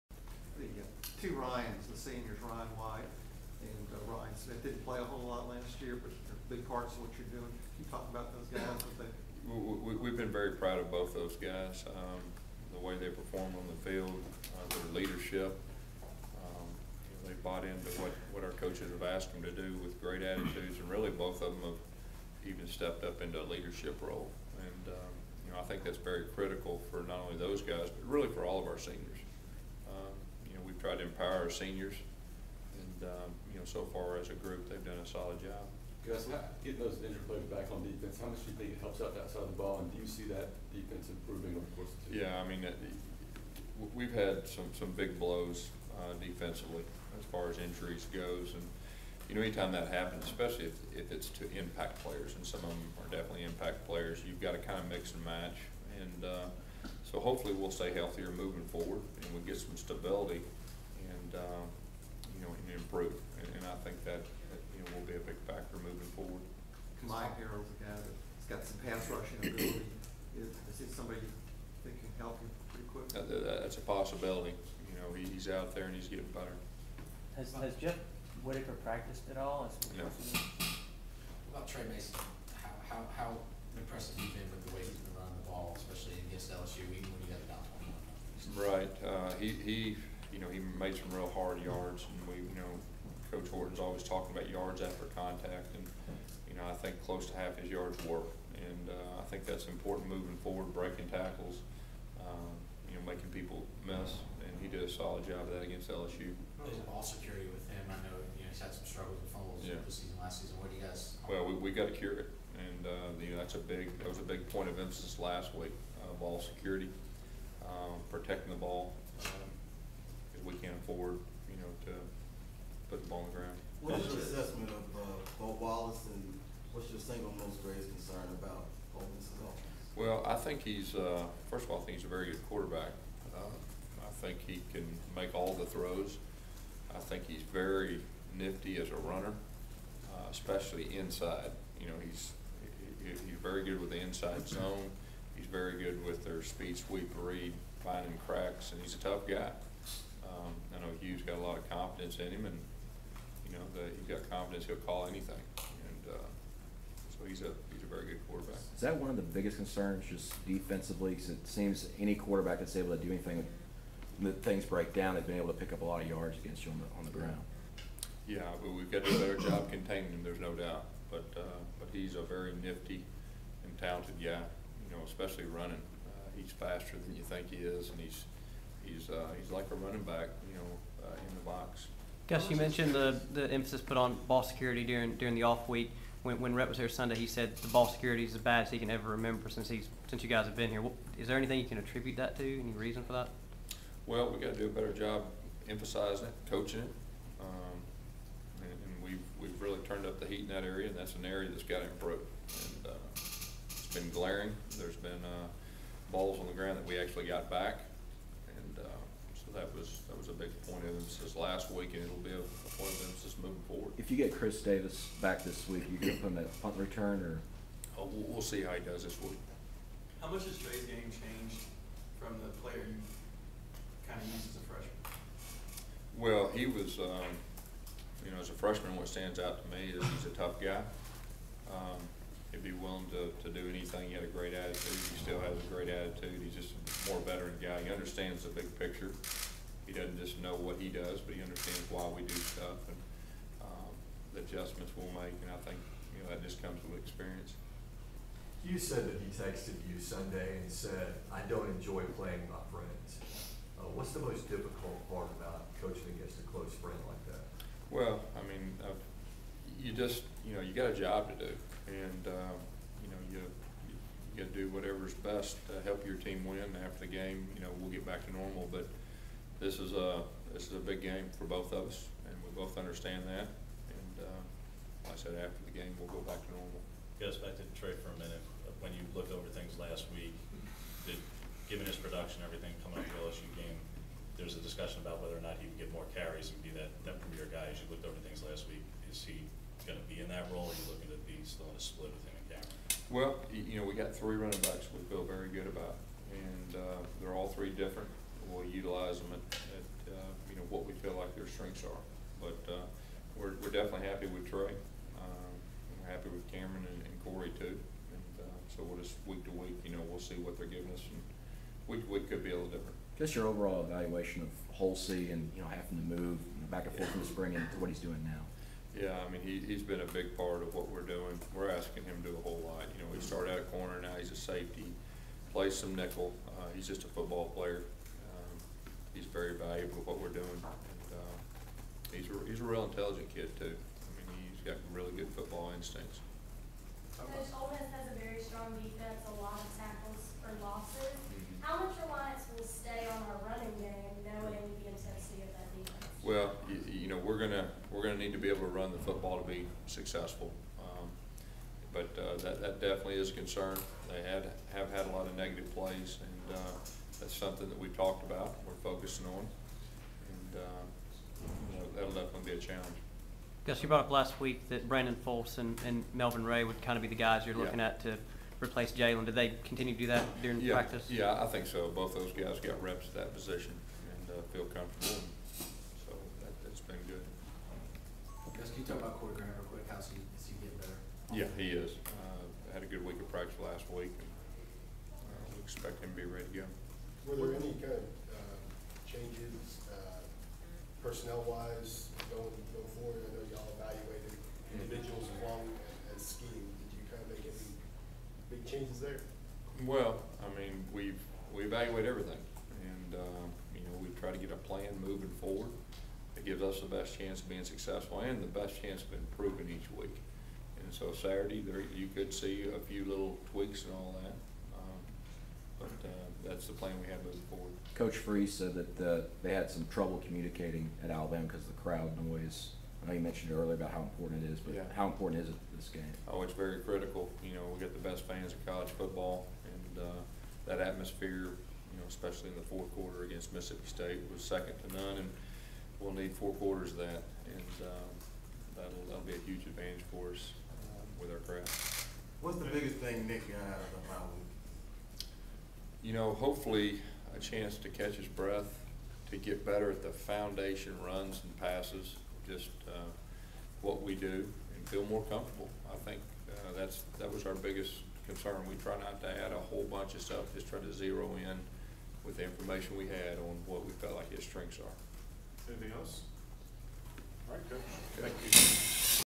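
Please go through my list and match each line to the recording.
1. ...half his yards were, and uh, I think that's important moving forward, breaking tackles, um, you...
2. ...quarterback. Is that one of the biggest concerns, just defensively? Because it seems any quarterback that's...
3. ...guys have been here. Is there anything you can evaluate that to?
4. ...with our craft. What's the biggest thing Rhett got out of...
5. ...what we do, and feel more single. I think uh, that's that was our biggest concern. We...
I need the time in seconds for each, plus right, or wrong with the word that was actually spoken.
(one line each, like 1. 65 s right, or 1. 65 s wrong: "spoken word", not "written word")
1. 97 s right
2. 158 s right
3. 190 s wrong: "attribute", not "evaluate"
4. 441 s wrong: "Nick", not "Rhett"
5. 453 s wrong: "comfortable", not "single".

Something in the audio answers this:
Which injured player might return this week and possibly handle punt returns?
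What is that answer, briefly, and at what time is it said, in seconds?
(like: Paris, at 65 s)
Chris Davis, at 214 s.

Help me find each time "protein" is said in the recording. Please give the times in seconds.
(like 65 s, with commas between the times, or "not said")
not said.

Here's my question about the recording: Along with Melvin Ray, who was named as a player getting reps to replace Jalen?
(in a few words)
Brandon Fulse.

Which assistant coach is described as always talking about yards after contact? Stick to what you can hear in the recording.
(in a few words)
Coach Horton.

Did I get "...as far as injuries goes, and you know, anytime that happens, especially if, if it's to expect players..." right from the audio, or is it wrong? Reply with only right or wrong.
wrong.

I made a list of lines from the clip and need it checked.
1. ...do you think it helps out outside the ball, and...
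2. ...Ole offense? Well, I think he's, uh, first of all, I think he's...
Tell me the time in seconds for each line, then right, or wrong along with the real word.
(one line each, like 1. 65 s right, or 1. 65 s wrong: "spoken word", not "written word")
1. 38 s right
2. 128 s right.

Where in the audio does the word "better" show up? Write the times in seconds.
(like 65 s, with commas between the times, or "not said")
76 s, 169 s, 194 s, 380 s, 449 s.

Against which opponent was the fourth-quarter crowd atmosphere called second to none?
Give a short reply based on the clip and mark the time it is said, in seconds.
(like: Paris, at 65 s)
Mississippi State, at 433 s.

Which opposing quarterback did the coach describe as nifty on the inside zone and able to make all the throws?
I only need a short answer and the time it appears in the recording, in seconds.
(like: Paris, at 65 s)
Bo Wallace, at 125 s.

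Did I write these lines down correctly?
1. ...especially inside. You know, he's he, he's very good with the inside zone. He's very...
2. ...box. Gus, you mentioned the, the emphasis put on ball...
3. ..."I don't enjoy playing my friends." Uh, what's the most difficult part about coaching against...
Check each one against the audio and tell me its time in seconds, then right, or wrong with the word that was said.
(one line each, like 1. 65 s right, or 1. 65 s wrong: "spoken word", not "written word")
1. 140 s right
2. 181 s right
3. 251 s right.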